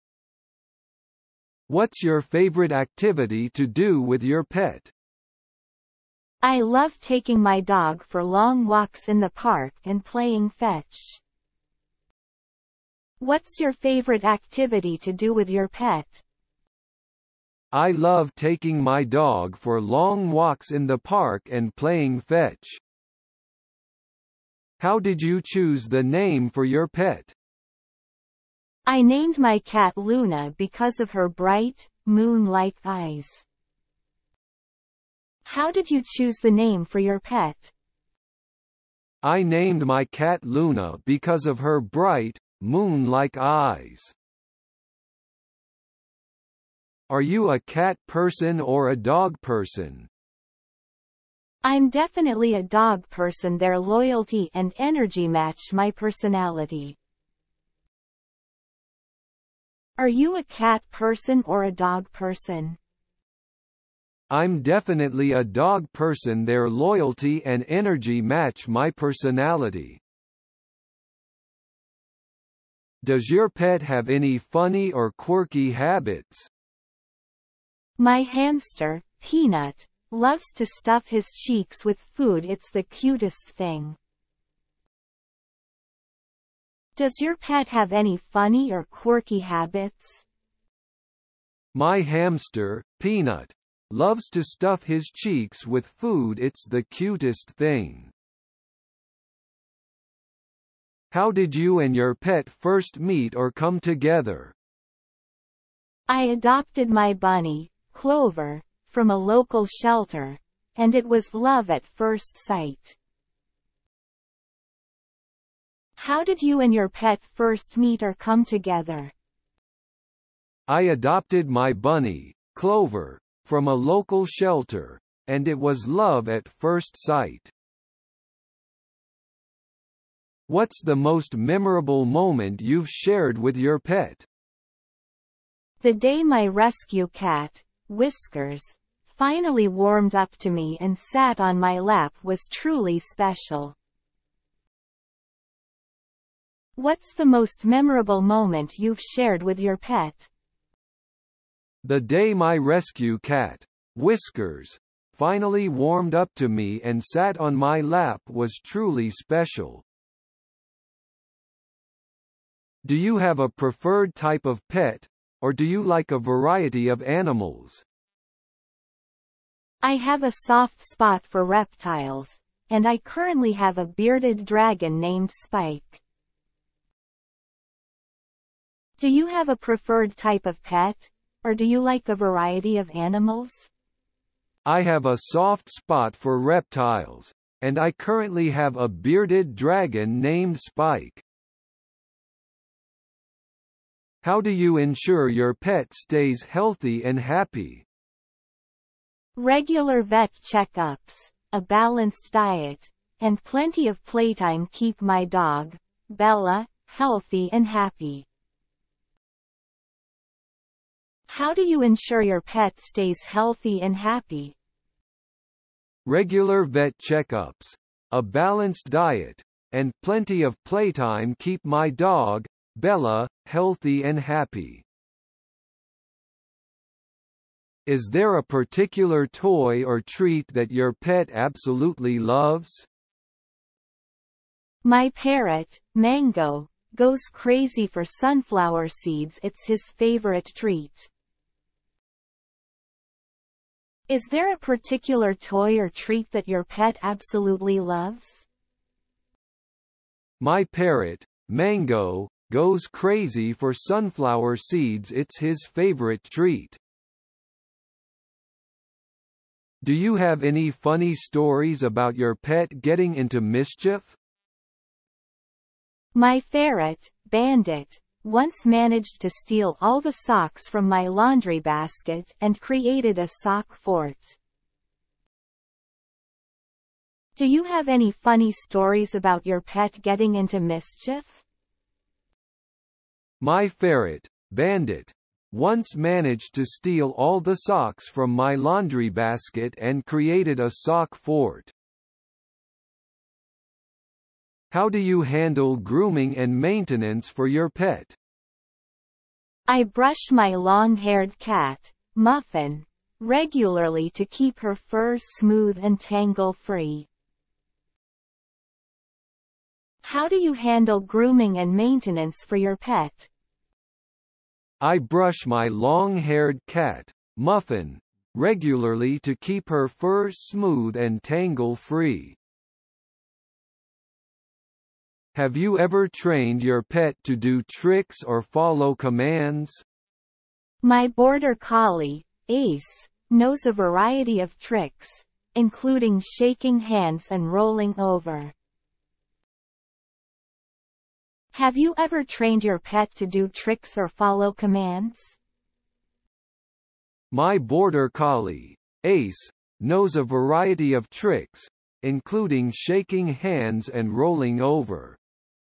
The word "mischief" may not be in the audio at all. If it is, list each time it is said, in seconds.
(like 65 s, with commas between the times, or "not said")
263 s, 280 s.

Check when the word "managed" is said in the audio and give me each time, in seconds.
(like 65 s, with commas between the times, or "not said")
268 s, 285 s.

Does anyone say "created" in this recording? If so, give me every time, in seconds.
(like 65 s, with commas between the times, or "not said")
272 s, 290 s.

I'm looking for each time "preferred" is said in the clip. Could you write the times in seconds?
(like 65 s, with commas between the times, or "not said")
163 s, 179 s.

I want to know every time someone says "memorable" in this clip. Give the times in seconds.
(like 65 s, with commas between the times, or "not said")
131 s, 147 s.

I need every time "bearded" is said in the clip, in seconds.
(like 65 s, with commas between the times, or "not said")
173 s, 188 s.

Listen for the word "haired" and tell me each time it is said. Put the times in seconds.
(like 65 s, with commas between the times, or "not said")
300 s, 315 s.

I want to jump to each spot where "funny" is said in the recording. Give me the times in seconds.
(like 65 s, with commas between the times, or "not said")
74 s, 88 s, 260 s, 278 s.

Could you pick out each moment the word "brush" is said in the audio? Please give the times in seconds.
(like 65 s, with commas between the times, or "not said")
299 s, 314 s.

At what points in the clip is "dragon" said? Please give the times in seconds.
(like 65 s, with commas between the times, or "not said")
174 s, 189 s.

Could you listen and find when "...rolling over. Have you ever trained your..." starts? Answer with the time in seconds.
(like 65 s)
337 s.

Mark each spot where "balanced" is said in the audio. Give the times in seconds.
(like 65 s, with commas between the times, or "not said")
201 s, 218 s.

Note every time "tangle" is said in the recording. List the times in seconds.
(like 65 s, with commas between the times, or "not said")
305 s, 321 s.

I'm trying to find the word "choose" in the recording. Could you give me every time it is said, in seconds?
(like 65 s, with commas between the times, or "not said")
25 s, 36 s.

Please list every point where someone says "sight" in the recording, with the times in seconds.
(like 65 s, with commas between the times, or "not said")
112 s, 126 s.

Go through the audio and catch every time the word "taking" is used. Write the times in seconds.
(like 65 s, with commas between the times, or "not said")
6 s, 18 s.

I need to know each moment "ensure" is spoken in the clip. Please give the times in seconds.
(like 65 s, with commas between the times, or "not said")
194 s, 211 s.